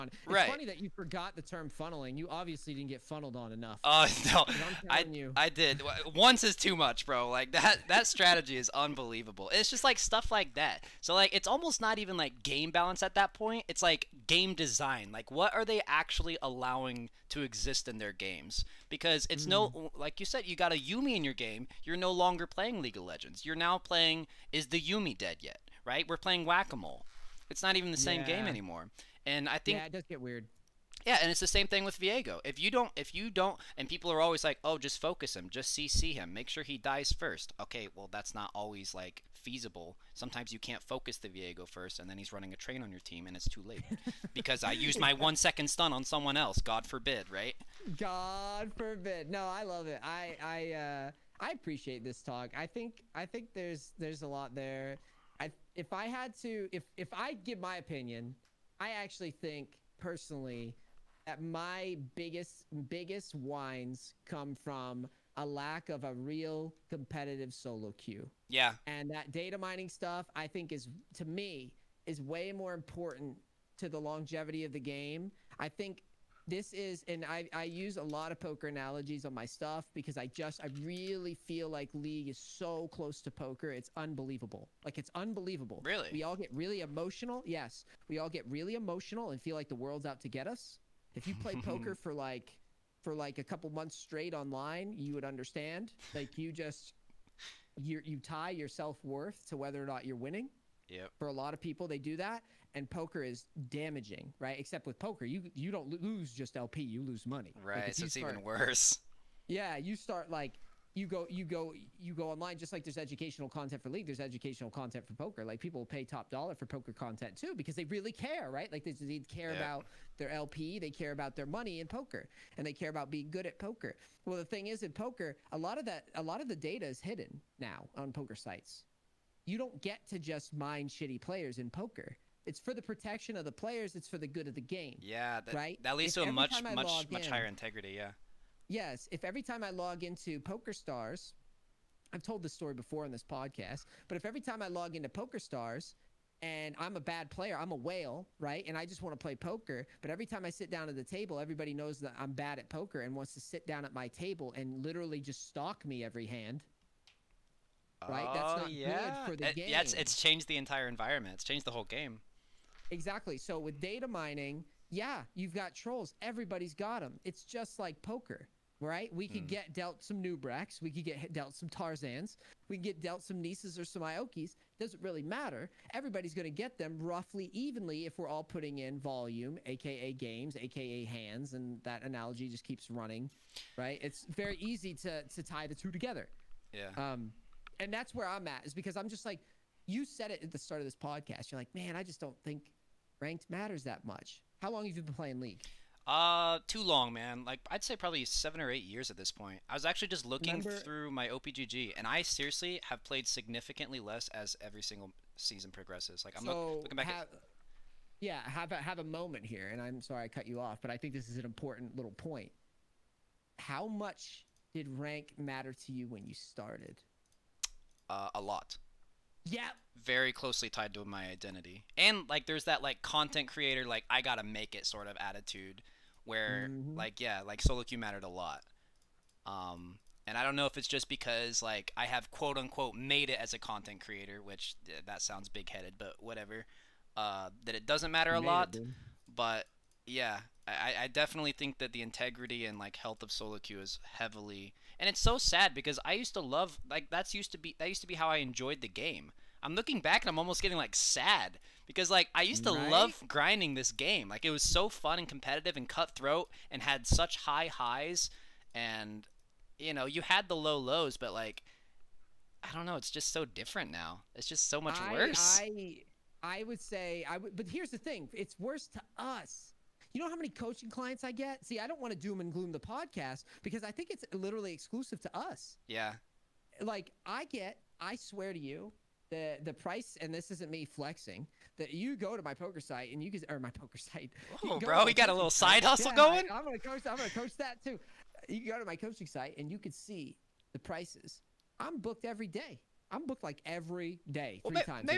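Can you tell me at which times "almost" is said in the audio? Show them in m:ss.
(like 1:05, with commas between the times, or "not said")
0:11, 4:10.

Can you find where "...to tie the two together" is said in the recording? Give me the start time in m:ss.
3:05.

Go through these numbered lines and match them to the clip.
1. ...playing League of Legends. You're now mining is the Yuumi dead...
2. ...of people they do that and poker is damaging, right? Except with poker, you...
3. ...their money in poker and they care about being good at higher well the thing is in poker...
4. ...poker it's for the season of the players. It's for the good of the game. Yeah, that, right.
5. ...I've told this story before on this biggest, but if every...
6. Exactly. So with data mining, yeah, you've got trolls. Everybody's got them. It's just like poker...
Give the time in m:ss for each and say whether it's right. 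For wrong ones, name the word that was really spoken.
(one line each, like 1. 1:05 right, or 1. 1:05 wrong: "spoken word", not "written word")
1. 0:22 wrong: "playing", not "mining"
2. 1:41 right
3. 2:01 wrong: "poker", not "higher"
4. 2:11 wrong: "protection", not "season"
5. 2:22 wrong: "podcast", not "biggest"
6. 2:42 right.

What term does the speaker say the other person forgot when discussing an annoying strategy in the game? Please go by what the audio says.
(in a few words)
funneling.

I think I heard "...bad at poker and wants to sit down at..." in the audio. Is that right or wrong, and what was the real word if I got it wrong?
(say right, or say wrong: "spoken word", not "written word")
right.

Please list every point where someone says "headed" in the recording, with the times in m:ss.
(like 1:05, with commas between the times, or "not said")
3:55.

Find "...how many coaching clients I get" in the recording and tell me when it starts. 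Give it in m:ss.
4:30.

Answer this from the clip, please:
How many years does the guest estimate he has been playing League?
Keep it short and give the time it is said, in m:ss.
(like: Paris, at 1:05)
7 or 8, at 3:18.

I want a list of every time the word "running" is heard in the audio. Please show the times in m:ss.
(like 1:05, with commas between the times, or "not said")
0:42, 3:02.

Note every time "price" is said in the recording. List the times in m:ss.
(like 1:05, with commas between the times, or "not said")
4:39, 4:50.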